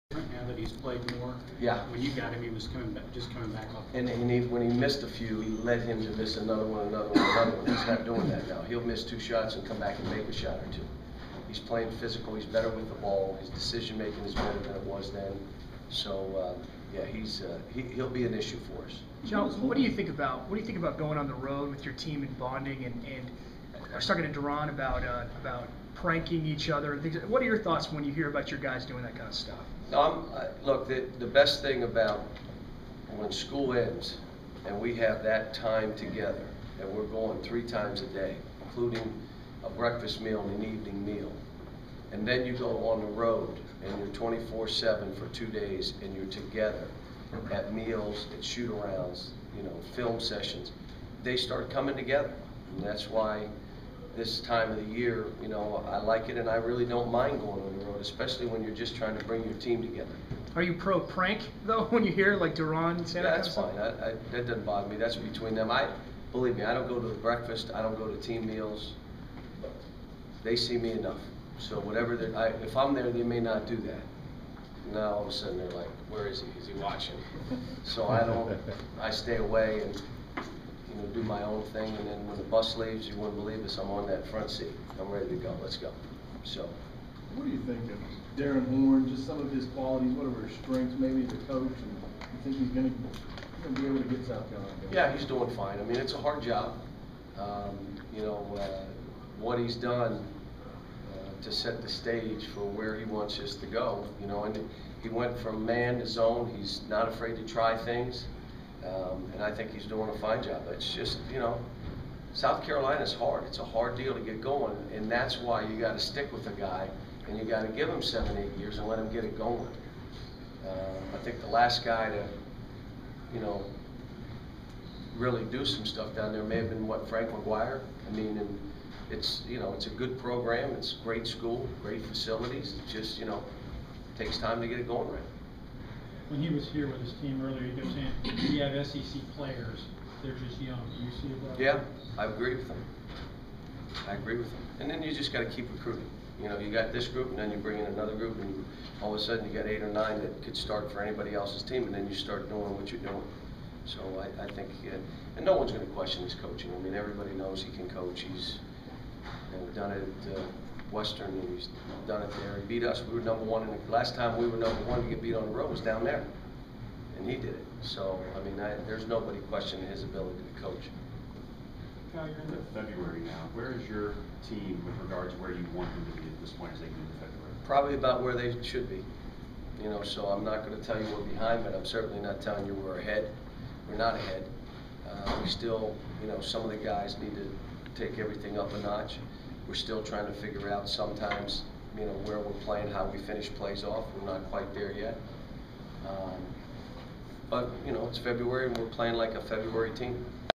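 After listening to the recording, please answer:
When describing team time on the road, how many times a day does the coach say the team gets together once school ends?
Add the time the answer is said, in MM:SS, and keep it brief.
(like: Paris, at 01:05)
3, at 00:37.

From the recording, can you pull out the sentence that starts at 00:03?
And, and he, when he missed a few, he led him to miss another one, another one, another one.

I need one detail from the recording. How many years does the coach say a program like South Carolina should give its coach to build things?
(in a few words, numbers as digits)
7 or 8.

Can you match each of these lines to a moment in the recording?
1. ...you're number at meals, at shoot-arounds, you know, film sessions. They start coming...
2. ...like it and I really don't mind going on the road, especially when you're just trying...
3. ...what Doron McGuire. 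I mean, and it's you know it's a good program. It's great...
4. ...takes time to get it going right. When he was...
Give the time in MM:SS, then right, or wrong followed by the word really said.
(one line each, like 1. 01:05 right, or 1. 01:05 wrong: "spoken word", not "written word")
1. 00:46 wrong: "together", not "number"
2. 00:55 right
3. 02:06 wrong: "Frank", not "Doron"
4. 02:14 right.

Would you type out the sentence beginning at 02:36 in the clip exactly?
I mean, everybody knows he can coach.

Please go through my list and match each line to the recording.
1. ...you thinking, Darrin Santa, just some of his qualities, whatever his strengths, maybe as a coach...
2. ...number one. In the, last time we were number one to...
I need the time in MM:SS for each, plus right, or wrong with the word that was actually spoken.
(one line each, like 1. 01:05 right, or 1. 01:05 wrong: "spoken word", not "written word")
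1. 01:27 wrong: "Horn", not "Santa"
2. 02:43 right.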